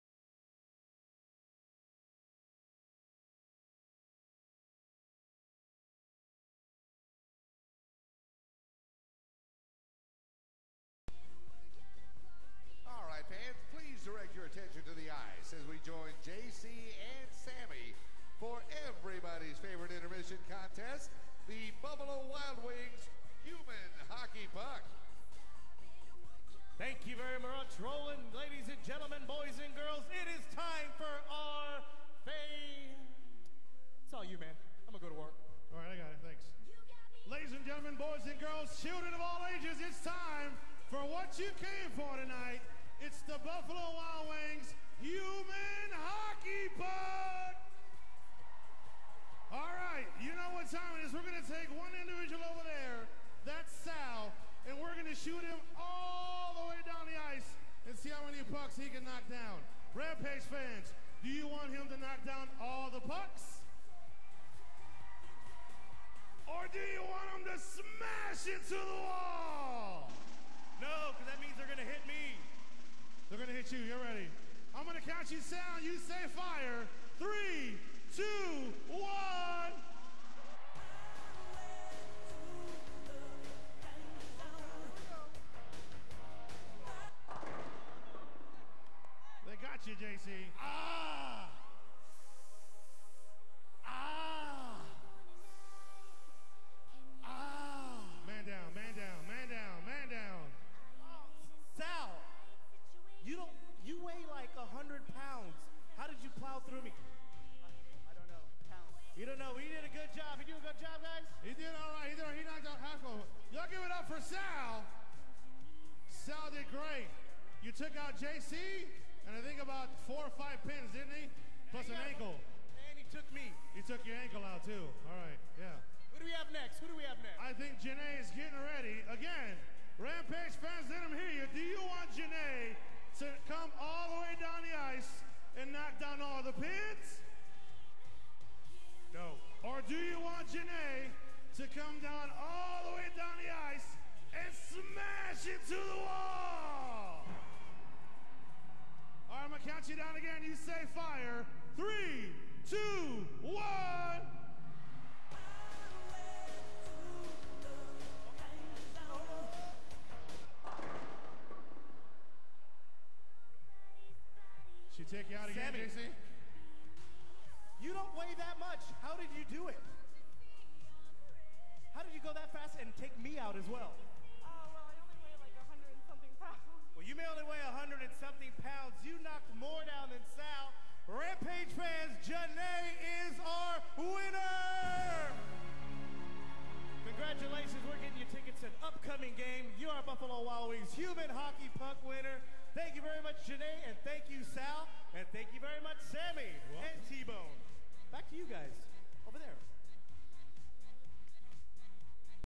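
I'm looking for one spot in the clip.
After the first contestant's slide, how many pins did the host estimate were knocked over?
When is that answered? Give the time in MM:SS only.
02:00.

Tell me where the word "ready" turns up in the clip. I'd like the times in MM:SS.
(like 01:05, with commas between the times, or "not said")
01:13, 02:08.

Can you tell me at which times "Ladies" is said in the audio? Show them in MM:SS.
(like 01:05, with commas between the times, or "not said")
00:28, 00:37.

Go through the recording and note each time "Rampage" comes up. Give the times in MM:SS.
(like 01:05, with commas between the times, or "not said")
00:59, 02:10.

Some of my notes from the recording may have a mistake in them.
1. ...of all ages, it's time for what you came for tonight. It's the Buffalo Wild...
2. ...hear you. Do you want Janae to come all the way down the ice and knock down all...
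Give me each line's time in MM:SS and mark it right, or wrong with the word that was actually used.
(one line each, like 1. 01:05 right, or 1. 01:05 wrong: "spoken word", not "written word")
1. 00:39 right
2. 02:11 right.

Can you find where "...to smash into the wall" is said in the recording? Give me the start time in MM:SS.
01:07.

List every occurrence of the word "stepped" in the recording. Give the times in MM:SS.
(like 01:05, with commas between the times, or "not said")
not said.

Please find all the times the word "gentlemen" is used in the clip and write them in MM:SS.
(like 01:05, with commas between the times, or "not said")
00:28, 00:37.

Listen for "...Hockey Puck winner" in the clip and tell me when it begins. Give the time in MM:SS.
03:11.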